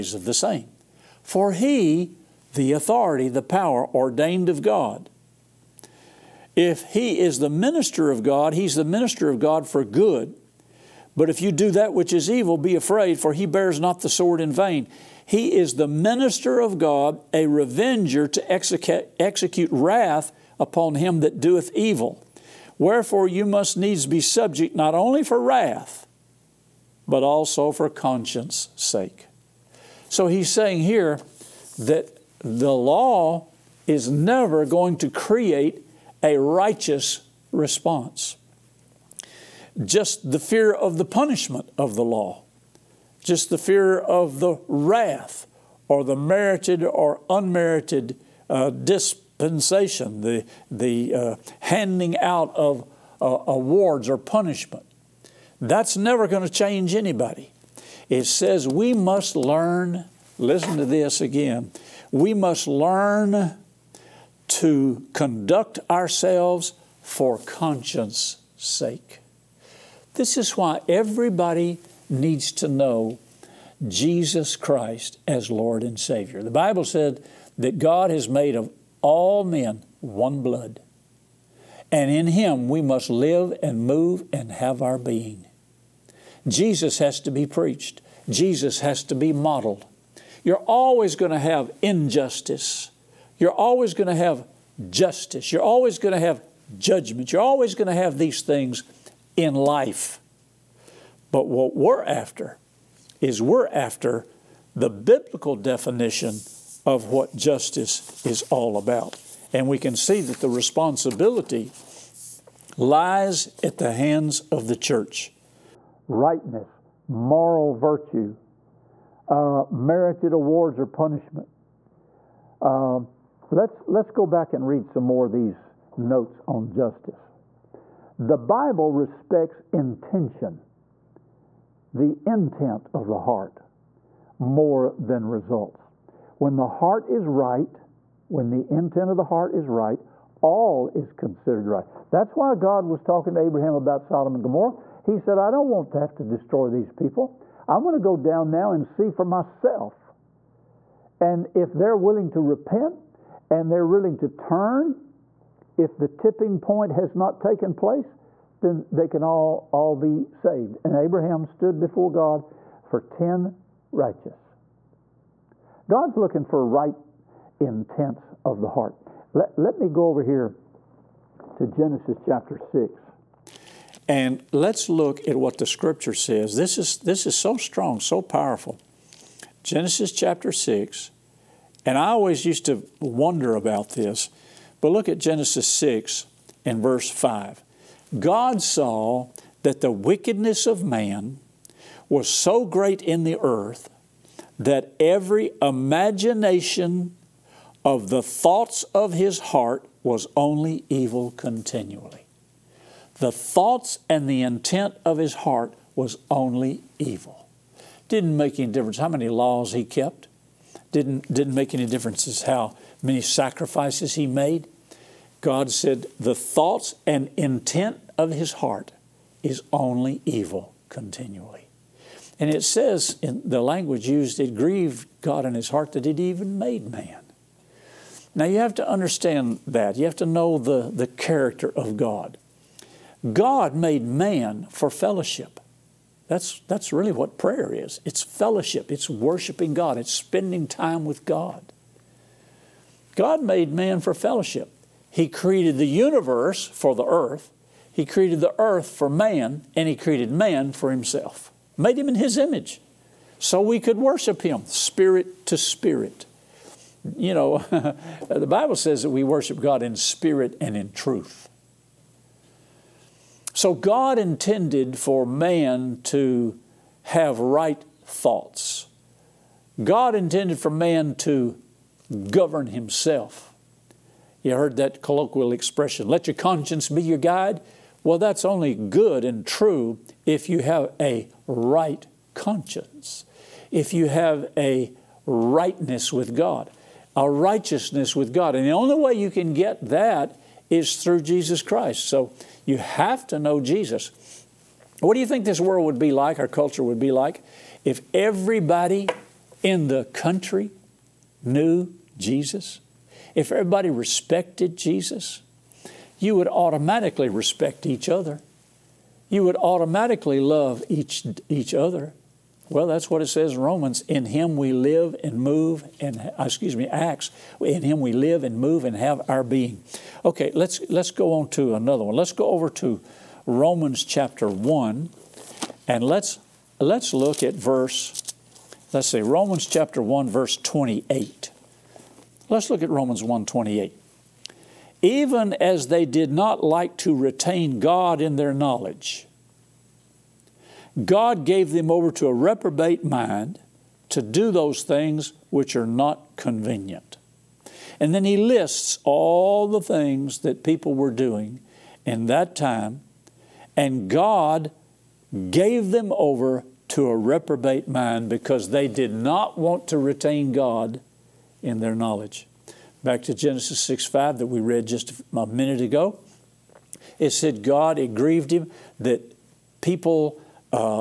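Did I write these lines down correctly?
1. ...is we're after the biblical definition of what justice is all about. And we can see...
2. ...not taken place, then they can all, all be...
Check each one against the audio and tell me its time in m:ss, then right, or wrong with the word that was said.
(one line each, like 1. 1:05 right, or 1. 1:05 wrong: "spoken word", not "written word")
1. 1:43 right
2. 2:37 right.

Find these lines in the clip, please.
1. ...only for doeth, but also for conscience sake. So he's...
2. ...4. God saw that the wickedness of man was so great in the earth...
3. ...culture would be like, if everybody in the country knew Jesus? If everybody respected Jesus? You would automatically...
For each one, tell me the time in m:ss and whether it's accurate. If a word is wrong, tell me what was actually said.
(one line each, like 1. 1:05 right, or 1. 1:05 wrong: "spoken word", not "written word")
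1. 0:24 wrong: "wrath", not "doeth"
2. 3:07 wrong: "5", not "4"
3. 4:56 right.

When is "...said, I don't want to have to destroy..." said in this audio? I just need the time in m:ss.
2:25.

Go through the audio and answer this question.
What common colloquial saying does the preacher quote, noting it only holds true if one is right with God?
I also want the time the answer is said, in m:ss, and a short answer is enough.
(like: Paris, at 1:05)
Let your conscience be your guide, at 4:36.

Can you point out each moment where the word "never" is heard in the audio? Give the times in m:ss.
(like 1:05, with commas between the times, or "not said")
0:34, 0:55.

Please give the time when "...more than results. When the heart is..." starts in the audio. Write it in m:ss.
2:14.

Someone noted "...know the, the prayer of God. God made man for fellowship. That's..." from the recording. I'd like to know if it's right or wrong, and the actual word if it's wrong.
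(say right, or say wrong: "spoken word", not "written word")
wrong: "character", not "prayer".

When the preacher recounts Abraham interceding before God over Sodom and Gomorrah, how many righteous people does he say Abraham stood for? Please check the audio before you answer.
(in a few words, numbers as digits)
10.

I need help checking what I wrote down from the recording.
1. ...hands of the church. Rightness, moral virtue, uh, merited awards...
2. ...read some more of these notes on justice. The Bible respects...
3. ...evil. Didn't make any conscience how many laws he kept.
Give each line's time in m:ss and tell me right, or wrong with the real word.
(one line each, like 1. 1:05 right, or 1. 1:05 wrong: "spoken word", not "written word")
1. 1:53 right
2. 2:04 right
3. 3:26 wrong: "difference", not "conscience".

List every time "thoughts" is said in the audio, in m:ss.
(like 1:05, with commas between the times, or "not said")
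3:18, 3:23, 3:36, 4:28.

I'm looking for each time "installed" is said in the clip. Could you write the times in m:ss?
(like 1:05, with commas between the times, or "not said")
not said.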